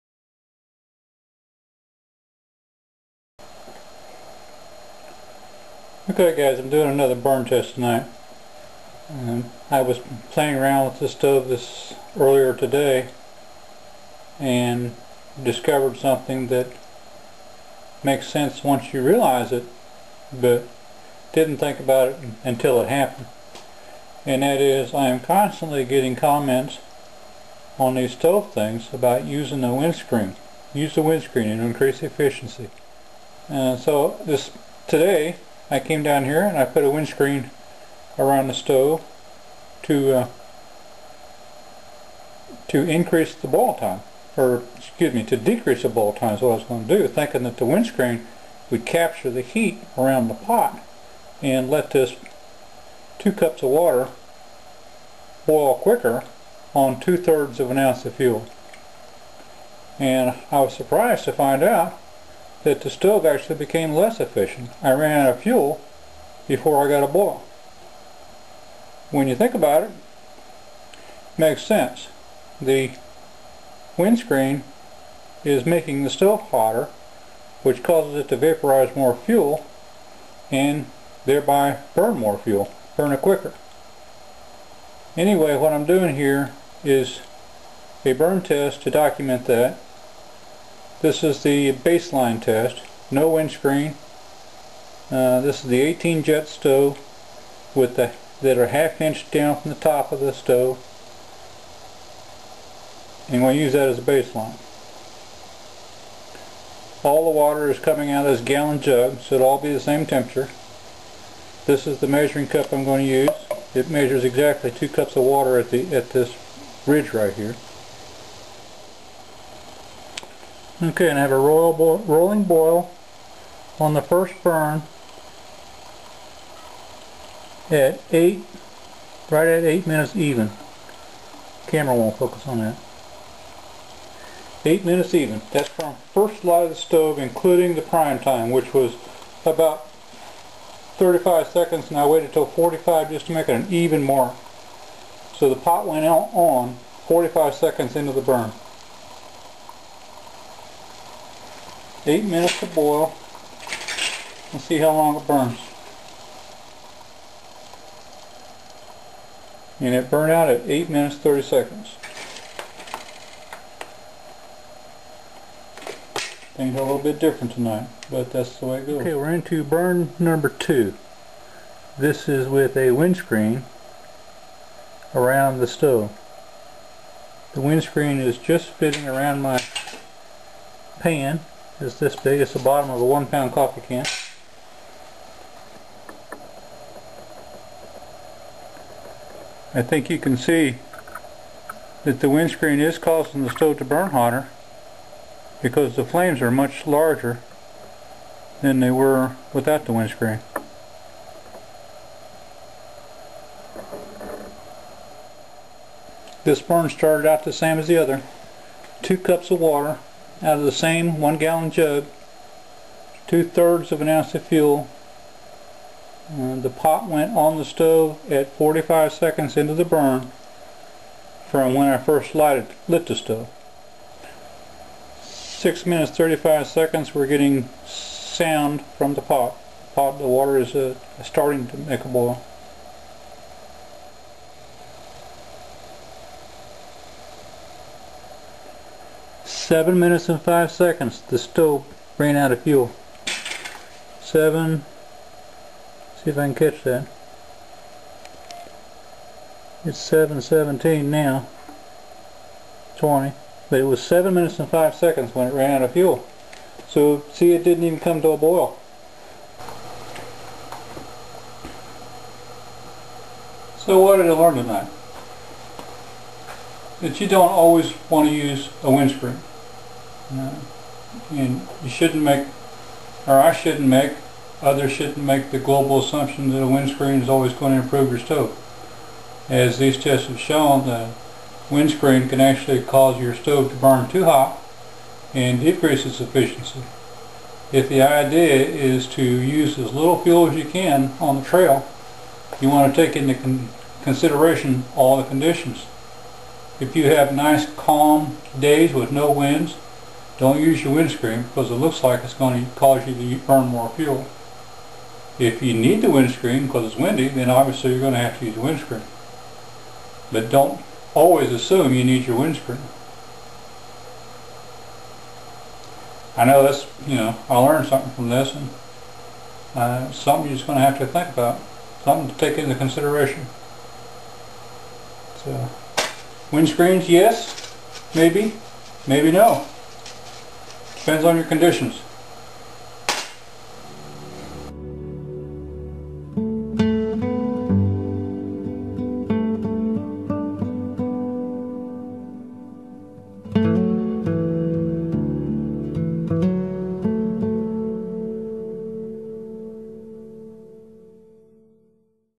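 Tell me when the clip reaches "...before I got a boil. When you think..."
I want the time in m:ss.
1:06.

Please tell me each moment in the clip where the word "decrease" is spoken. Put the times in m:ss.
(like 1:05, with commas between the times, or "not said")
0:45, 4:45.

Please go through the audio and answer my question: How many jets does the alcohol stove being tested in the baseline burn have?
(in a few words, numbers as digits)
18.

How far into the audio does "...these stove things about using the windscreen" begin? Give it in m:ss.
0:27.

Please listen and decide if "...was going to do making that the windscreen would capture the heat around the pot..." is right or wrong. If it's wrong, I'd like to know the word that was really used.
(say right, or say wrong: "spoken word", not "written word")
wrong: "thinking", not "making".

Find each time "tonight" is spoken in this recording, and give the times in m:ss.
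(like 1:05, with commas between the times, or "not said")
0:07, 2:47, 4:24.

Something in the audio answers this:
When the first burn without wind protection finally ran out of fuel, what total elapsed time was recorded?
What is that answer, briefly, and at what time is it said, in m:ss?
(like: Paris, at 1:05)
8 minutes 30 seconds, at 2:40.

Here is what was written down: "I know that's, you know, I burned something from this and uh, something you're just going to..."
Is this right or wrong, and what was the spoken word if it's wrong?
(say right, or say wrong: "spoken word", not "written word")
wrong: "learned", not "burned".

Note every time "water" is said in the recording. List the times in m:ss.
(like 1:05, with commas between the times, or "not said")
0:53, 1:47, 1:55, 3:29, 3:50.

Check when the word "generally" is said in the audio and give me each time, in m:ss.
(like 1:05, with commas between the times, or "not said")
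not said.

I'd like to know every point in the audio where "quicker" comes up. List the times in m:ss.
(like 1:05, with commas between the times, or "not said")
0:55, 1:23.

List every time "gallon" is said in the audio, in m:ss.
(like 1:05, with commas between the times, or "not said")
1:48, 3:31.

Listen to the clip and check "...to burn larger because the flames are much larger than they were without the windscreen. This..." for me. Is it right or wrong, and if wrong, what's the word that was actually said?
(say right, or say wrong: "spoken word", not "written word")
wrong: "hotter", not "larger".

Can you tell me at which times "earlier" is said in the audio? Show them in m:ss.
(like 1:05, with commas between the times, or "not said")
0:12.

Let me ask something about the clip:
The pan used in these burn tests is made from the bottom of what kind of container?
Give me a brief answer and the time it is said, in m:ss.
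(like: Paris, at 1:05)
one pound coffee can, at 3:03.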